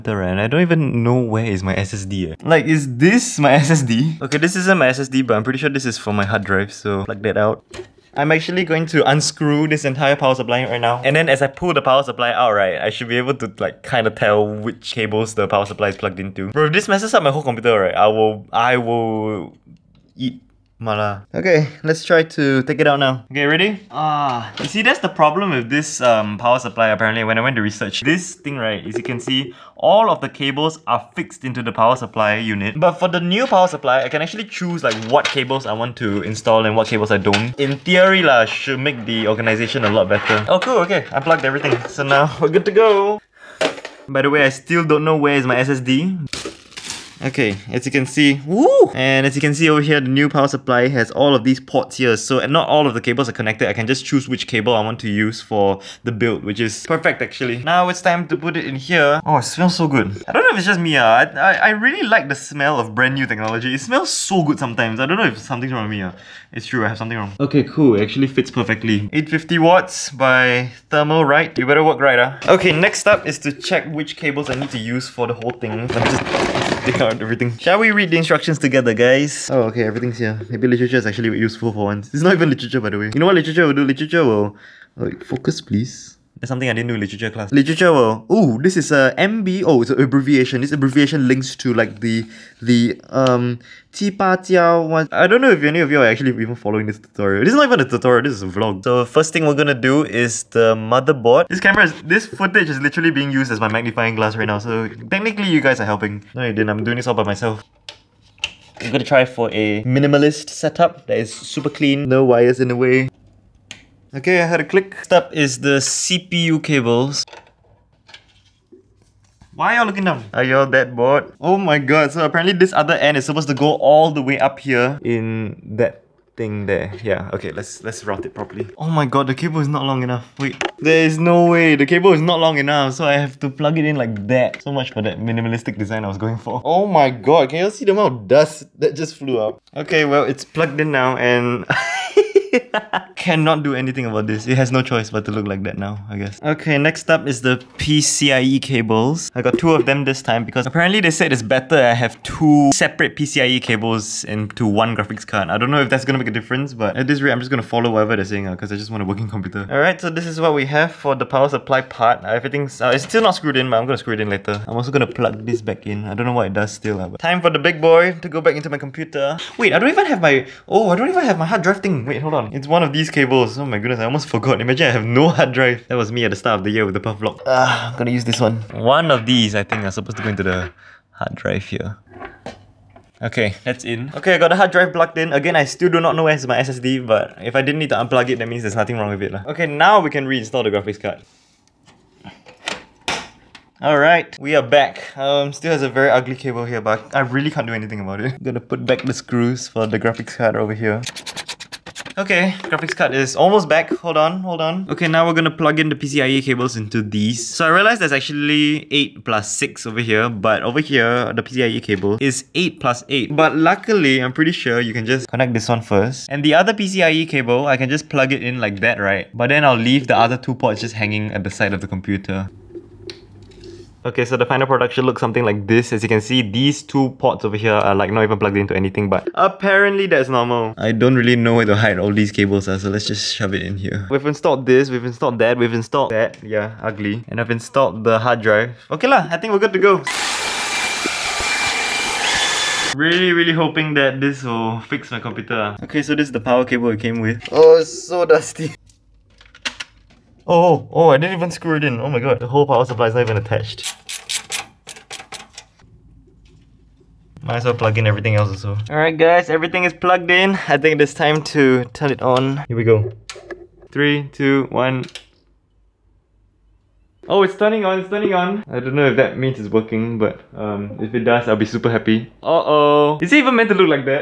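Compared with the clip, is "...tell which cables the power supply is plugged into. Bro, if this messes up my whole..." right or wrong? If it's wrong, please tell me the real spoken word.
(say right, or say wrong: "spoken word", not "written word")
right.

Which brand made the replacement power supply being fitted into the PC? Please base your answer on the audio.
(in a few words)
Thermalright.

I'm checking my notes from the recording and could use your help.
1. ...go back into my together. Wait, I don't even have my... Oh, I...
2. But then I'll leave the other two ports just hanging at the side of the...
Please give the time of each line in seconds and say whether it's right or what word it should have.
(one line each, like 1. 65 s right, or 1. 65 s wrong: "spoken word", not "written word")
1. 168 s wrong: "computer", not "together"
2. 219 s right.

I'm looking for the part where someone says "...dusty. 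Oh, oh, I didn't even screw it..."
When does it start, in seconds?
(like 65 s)
248 s.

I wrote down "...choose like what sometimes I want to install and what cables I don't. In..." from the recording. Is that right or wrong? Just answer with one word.
wrong.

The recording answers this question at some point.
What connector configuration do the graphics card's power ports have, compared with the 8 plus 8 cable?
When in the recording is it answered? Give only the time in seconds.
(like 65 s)
208 s.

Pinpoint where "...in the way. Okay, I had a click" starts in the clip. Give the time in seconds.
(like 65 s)
112 s.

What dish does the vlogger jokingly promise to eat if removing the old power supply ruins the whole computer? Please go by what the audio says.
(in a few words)
Mala.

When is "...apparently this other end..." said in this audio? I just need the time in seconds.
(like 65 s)
122 s.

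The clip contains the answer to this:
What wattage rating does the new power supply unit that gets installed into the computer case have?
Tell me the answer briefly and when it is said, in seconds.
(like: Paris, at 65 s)
850 watts, at 69 s.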